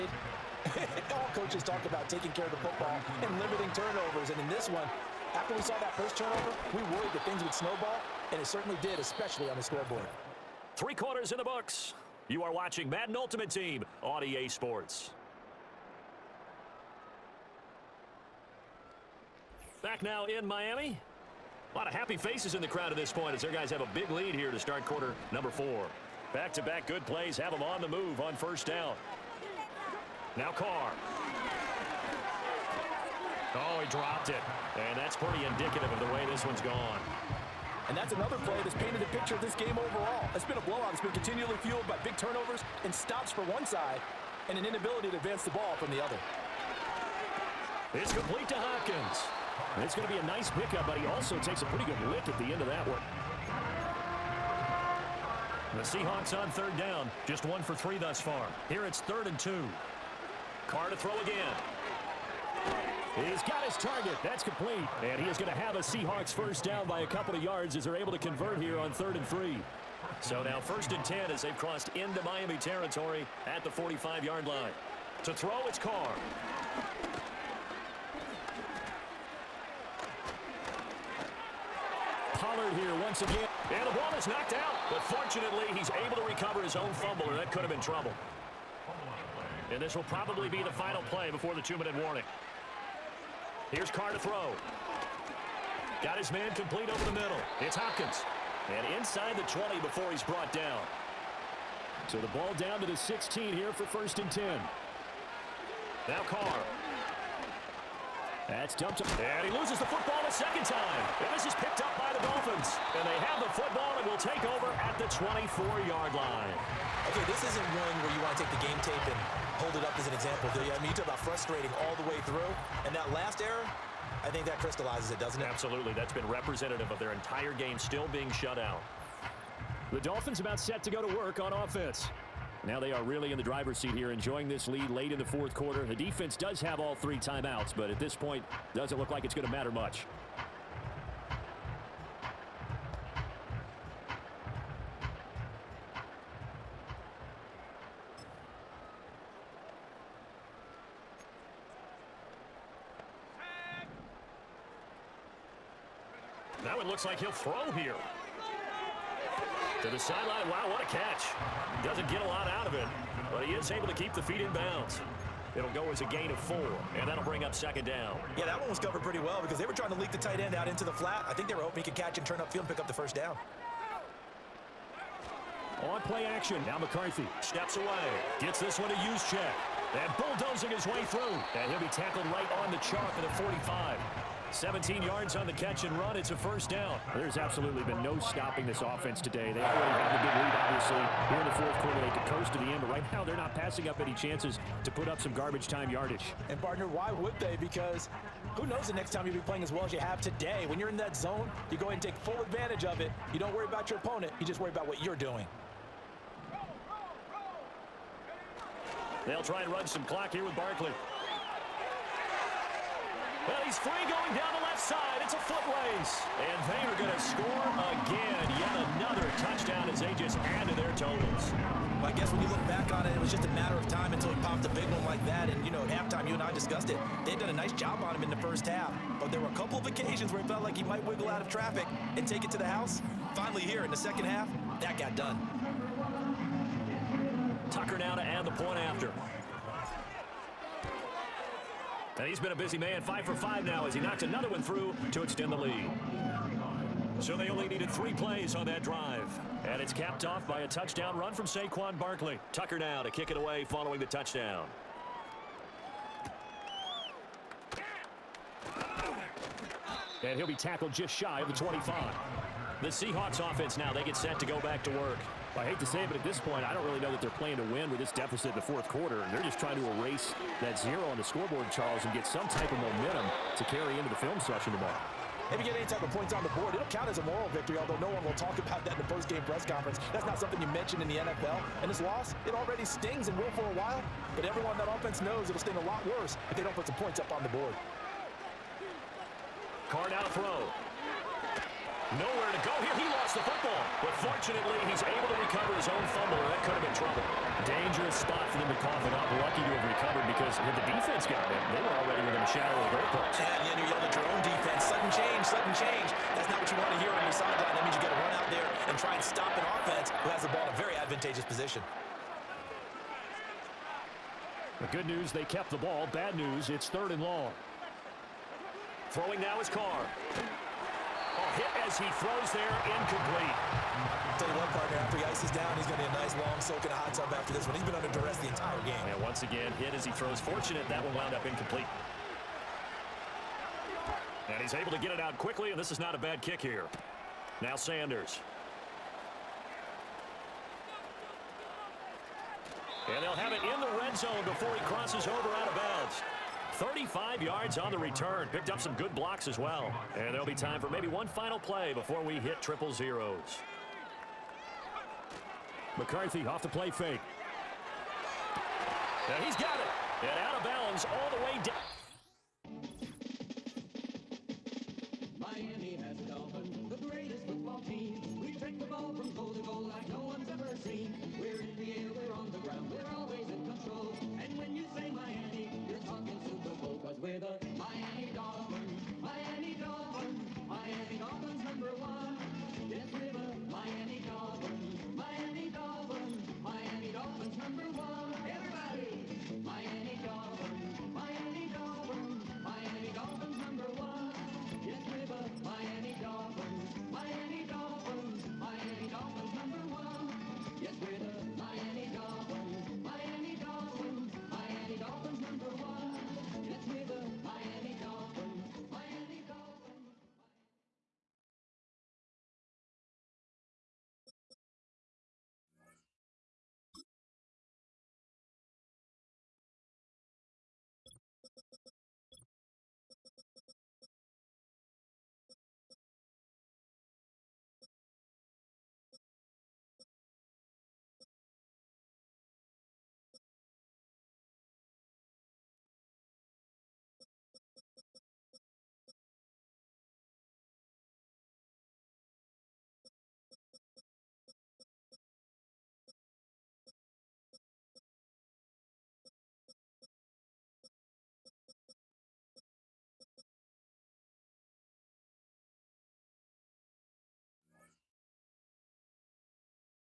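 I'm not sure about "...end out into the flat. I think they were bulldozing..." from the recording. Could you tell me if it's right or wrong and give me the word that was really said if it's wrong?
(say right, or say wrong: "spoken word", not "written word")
wrong: "hoping", not "bulldozing".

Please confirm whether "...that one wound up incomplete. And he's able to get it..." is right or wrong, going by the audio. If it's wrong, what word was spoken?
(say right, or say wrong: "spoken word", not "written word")
right.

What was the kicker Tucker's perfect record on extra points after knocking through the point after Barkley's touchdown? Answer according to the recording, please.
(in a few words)
5 for 5.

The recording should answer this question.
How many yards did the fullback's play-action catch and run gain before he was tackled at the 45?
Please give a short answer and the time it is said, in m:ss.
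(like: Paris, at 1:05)
17, at 3:04.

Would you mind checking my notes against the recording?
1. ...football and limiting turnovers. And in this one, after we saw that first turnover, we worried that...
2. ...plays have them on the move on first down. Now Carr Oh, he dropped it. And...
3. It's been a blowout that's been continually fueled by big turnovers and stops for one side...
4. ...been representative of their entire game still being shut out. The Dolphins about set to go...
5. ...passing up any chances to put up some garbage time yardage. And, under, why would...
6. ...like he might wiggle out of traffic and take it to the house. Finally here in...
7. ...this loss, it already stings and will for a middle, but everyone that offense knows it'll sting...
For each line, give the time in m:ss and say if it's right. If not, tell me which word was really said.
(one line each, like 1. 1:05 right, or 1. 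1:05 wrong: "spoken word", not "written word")
1. 0:02 right
2. 0:27 right
3. 0:40 right
4. 2:06 right
5. 3:13 wrong: "partner", not "under"
6. 3:50 right
7. 4:41 wrong: "while", not "middle".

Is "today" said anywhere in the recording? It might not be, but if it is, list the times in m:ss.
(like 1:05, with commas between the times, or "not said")
3:09, 3:20.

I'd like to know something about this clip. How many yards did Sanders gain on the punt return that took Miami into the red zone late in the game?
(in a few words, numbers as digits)
35.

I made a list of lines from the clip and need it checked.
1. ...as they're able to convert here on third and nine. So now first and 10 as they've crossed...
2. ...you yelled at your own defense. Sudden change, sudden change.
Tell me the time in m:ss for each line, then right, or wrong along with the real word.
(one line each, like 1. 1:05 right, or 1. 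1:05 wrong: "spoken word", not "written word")
1. 1:07 wrong: "three", not "nine"
2. 5:03 right.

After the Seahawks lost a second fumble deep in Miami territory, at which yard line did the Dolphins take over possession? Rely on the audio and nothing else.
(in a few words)
24.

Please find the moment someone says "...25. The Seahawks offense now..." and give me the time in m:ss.
4:21.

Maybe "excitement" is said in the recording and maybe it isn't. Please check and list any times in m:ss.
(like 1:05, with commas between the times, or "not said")
not said.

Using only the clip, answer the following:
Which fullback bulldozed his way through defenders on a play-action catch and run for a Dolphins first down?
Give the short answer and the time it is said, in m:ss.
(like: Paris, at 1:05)
Juszczyk, at 2:58.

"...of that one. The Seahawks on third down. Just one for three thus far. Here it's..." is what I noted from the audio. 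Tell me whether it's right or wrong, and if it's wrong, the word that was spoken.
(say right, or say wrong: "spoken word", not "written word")
right.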